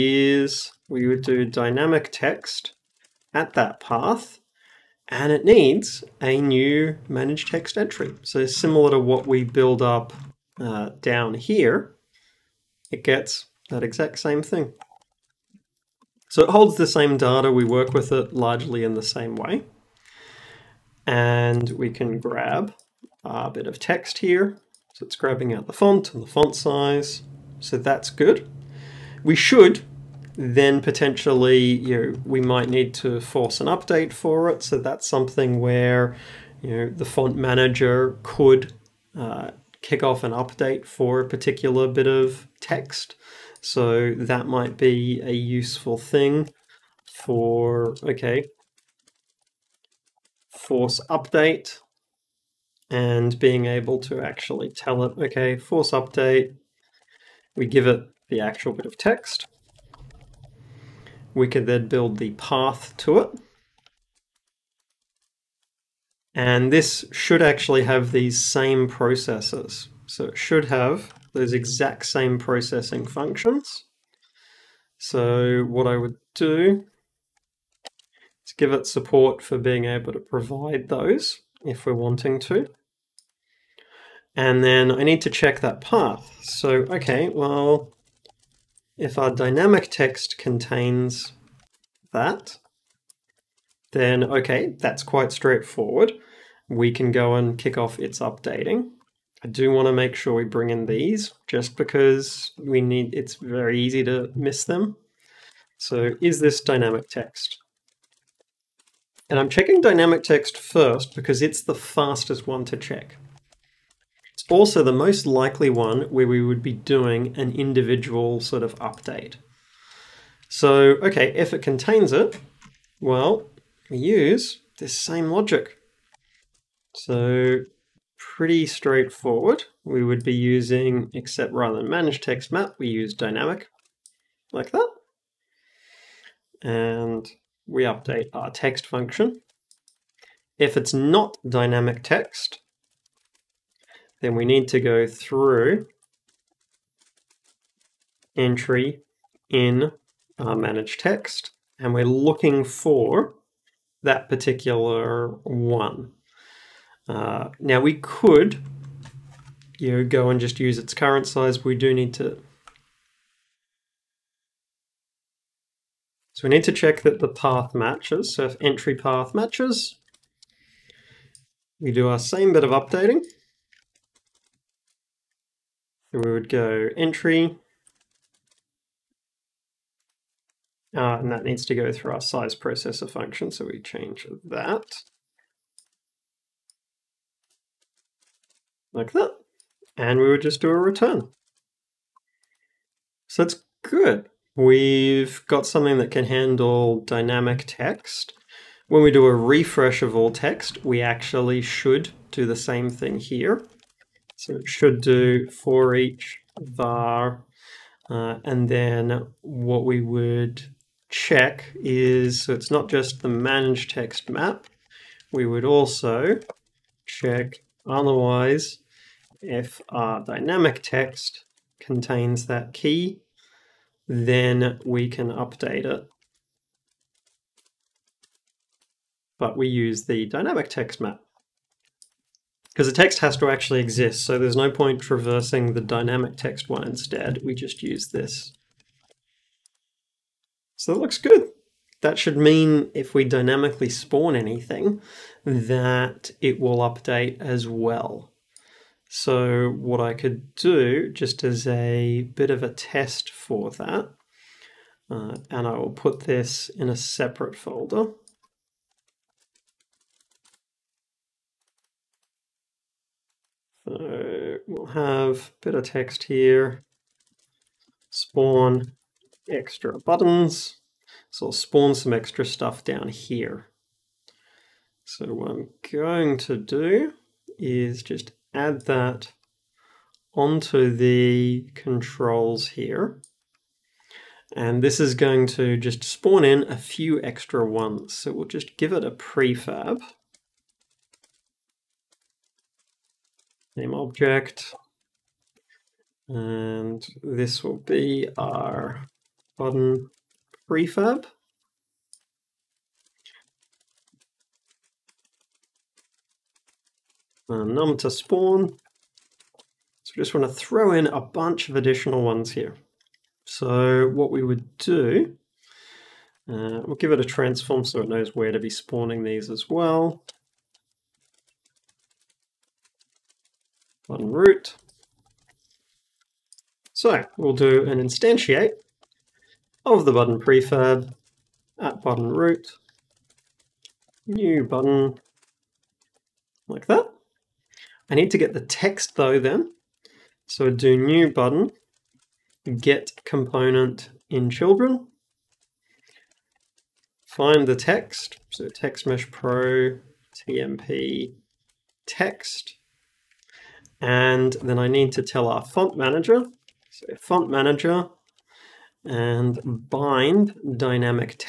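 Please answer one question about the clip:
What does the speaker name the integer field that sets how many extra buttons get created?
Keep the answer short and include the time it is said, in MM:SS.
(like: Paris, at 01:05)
num to spawn, at 05:07.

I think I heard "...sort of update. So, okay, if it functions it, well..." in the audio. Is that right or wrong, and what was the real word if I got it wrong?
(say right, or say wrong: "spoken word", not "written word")
wrong: "contains", not "functions".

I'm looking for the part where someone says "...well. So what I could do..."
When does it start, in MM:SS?
04:07.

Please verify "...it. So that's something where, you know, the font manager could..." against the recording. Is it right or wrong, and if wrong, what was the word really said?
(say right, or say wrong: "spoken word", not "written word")
right.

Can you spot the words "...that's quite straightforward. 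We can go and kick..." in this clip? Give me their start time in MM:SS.
01:34.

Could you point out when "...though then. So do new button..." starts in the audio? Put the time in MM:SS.
05:39.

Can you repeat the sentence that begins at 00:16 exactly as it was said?
So it holds the same data, we work with it largely in the same way.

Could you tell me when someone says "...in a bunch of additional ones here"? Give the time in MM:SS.
05:10.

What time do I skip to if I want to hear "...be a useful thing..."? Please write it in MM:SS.
00:44.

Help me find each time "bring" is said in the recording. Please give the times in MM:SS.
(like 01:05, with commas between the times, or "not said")
01:40.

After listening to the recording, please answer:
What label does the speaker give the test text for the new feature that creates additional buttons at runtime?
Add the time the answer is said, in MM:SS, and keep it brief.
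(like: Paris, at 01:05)
spawn extra buttons, at 04:28.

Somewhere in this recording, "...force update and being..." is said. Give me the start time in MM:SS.
00:50.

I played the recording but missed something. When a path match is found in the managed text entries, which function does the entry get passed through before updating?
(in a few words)
size processor.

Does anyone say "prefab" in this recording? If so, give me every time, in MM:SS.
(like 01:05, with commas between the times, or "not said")
04:49, 05:00, 05:30.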